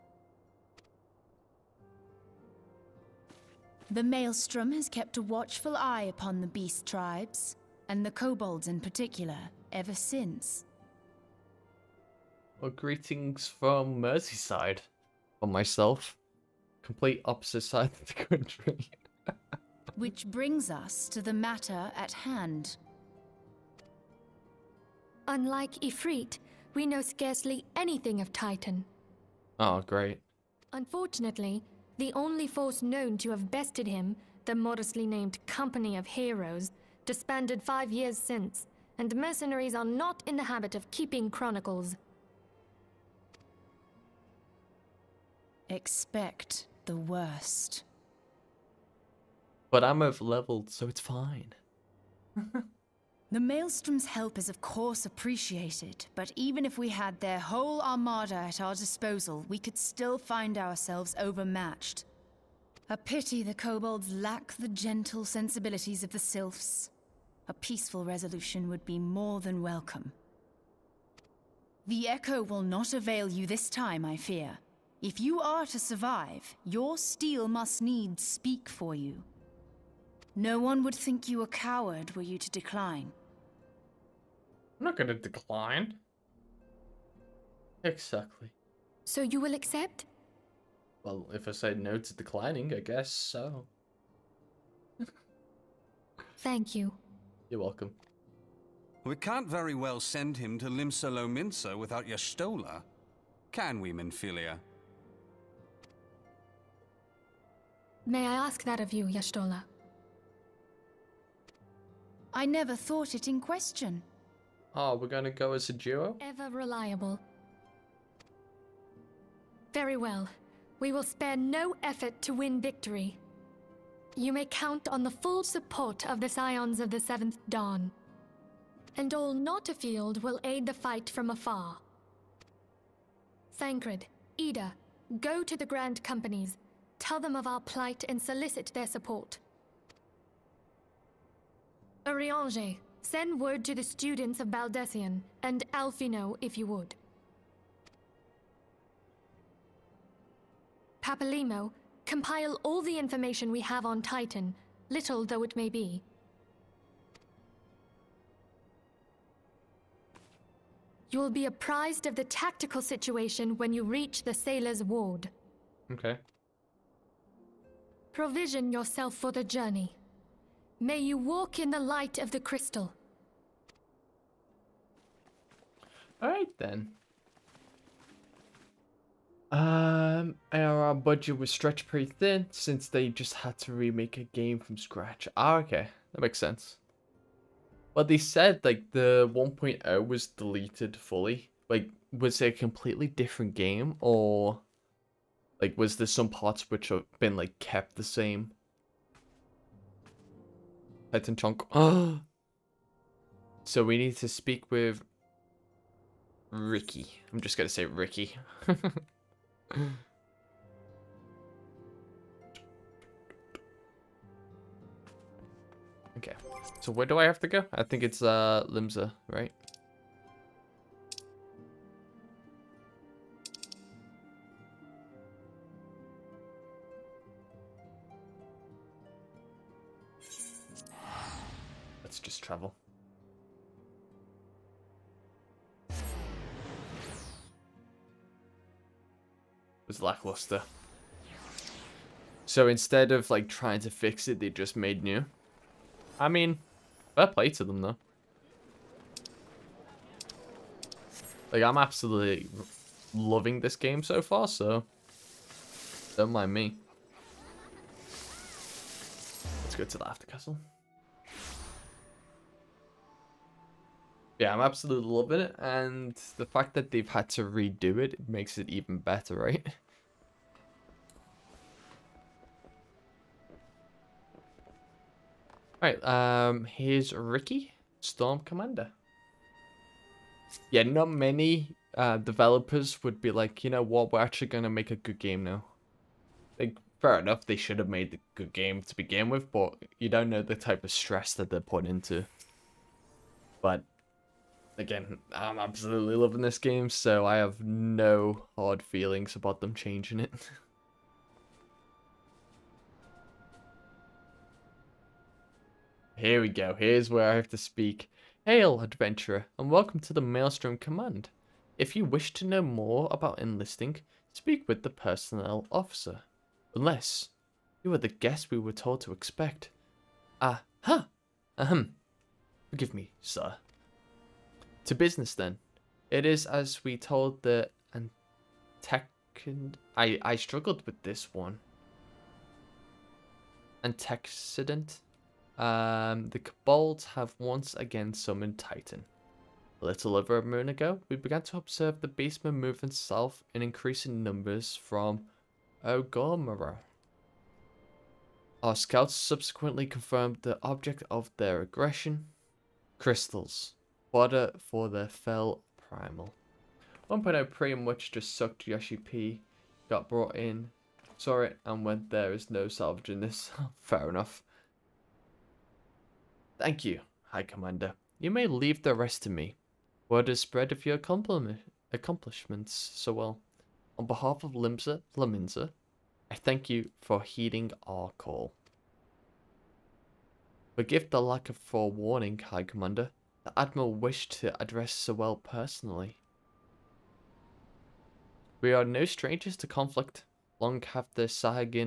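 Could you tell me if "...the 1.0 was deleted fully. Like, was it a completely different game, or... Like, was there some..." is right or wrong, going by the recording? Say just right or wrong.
right.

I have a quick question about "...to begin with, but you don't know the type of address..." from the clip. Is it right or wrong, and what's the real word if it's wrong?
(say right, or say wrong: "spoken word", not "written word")
wrong: "stress", not "address".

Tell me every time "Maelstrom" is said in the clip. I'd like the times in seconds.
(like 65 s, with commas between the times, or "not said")
4 s, 53 s, 310 s.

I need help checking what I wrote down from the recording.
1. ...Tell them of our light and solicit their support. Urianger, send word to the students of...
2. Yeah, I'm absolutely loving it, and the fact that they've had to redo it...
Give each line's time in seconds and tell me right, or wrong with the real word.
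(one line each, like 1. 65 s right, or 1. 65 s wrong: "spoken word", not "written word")
1. 136 s wrong: "plight", not "light"
2. 264 s right.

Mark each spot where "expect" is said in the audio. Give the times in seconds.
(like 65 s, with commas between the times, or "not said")
45 s, 319 s.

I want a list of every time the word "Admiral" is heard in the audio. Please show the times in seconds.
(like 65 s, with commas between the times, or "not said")
383 s.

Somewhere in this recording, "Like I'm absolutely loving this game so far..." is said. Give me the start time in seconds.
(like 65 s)
251 s.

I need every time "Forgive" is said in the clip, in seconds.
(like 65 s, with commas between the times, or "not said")
322 s, 380 s.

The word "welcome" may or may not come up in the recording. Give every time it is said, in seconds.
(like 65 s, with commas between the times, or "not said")
69 s, 97 s, 309 s.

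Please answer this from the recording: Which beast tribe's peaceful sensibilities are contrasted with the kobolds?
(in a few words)
Sylphs.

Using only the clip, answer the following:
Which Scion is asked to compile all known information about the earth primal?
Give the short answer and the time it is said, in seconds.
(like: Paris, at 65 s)
Papalymo, at 151 s.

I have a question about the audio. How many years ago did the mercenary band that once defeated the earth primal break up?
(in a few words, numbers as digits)
5.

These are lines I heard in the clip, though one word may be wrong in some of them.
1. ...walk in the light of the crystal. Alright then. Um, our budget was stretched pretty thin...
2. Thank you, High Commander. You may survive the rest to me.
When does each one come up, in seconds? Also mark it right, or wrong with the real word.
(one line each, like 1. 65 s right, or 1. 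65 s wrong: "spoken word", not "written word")
1. 171 s right
2. 366 s wrong: "leave", not "survive".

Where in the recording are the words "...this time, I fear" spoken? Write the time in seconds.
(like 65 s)
73 s.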